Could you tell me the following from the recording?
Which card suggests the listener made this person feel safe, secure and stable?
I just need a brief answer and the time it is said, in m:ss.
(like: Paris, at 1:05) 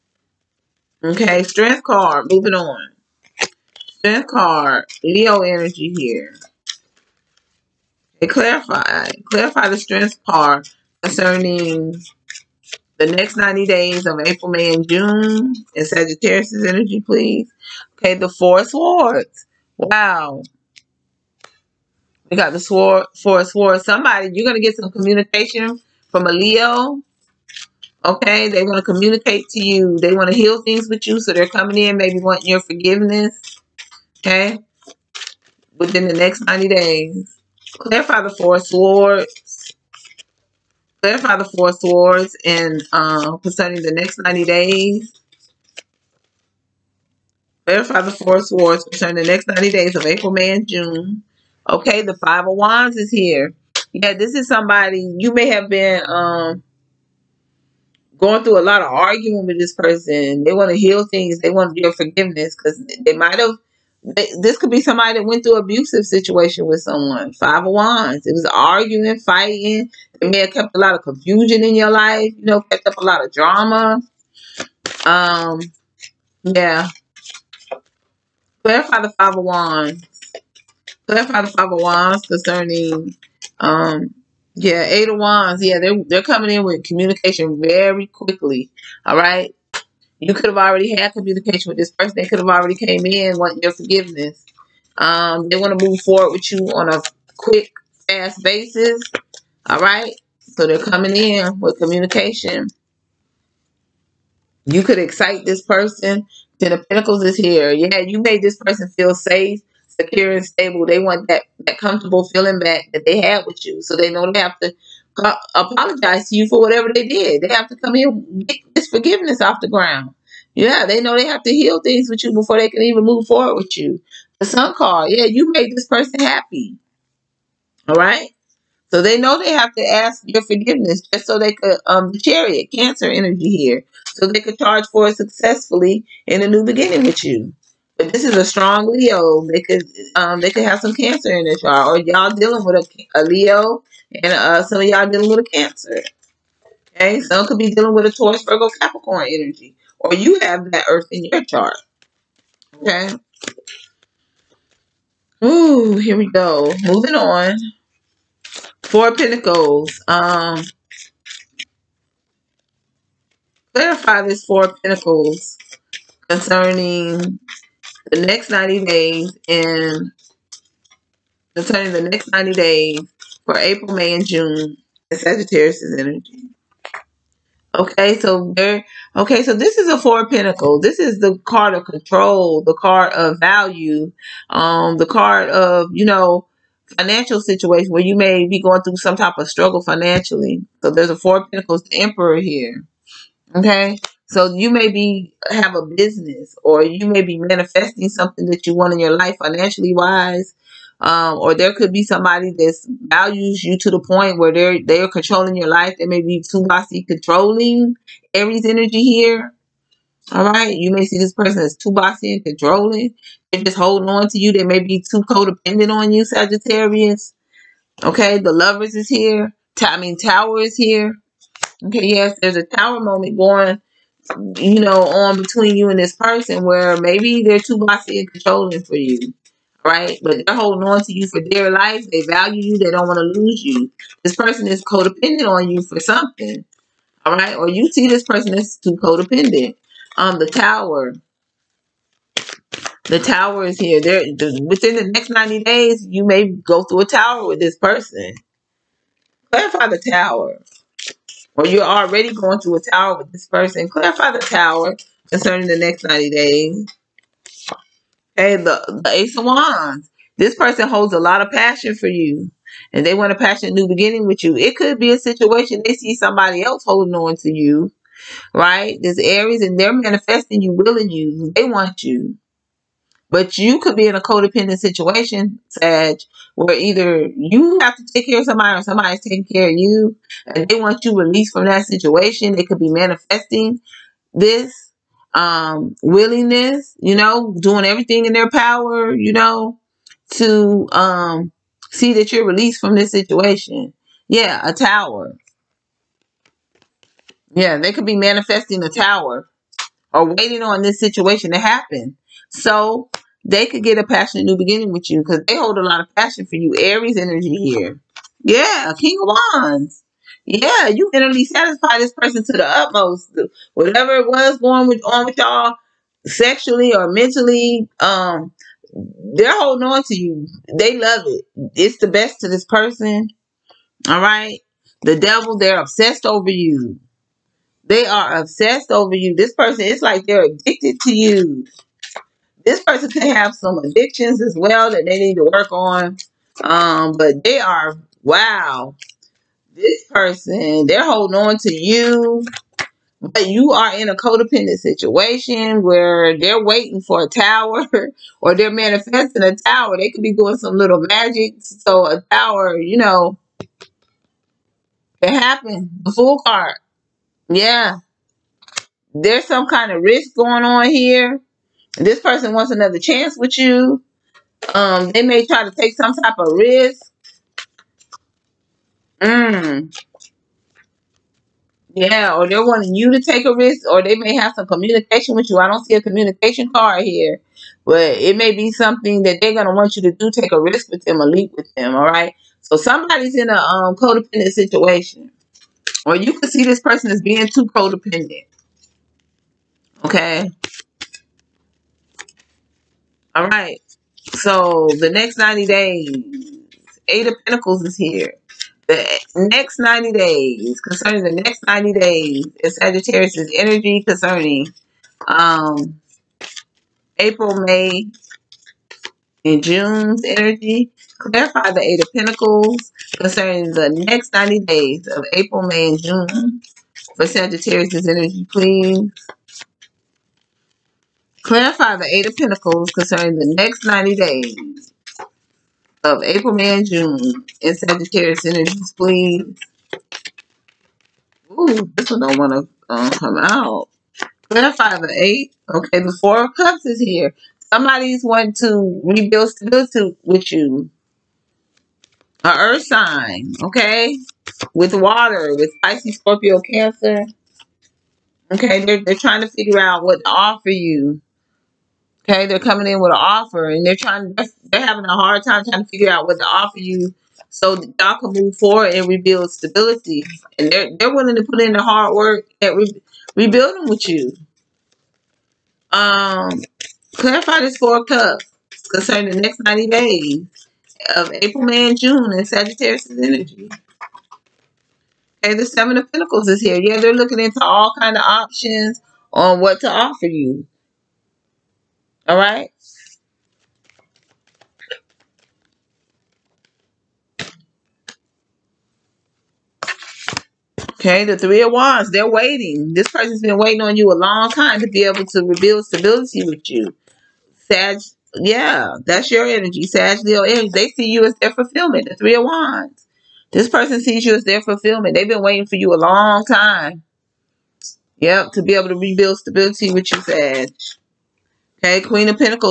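Ten of Pentacles, at 1:46.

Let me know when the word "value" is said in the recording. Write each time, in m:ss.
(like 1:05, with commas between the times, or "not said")
3:03, 3:23, 3:52.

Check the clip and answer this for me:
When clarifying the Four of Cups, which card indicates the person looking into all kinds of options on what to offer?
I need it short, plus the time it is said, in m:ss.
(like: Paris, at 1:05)
Seven of Pentacles, at 7:55.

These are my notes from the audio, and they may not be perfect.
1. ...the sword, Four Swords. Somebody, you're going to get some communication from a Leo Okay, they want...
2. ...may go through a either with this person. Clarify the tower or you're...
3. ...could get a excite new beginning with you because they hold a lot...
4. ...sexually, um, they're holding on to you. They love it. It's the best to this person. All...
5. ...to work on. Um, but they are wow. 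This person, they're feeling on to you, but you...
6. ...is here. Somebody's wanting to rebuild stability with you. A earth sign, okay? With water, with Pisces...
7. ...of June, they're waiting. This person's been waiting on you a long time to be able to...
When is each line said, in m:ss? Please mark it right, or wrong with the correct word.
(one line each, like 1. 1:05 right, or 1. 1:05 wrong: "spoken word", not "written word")
1. 0:22 right
2. 4:06 wrong: "tower", not "either"
3. 5:03 wrong: "passionate", not "excite"
4. 5:17 wrong: "mentally", not "sexually"
5. 5:35 wrong: "holding", not "feeling"
6. 7:16 right
7. 8:11 wrong: "Wands", not "June".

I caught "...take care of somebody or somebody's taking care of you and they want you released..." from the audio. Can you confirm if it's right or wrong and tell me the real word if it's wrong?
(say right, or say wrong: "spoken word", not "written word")
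right.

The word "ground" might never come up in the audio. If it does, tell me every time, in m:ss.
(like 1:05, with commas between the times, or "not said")
1:59.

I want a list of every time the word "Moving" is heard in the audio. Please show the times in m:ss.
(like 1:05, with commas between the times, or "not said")
0:02, 2:36.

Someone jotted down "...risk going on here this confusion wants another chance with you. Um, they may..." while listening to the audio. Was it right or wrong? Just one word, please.
wrong.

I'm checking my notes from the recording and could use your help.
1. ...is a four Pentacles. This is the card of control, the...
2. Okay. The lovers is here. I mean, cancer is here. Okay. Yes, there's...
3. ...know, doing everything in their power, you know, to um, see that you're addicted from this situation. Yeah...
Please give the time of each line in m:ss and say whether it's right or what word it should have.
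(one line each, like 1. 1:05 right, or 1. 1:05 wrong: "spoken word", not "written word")
1. 2:59 right
2. 3:38 wrong: "tower", not "cancer"
3. 4:47 wrong: "released", not "addicted".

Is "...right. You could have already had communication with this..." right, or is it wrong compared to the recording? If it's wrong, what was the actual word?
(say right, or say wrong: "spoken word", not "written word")
right.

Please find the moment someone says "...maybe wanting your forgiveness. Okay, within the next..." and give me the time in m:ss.
0:31.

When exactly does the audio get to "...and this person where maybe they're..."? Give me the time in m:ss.
3:45.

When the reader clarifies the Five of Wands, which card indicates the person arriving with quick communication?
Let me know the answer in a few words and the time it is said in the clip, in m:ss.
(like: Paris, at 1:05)
Eight of Wands, at 1:24.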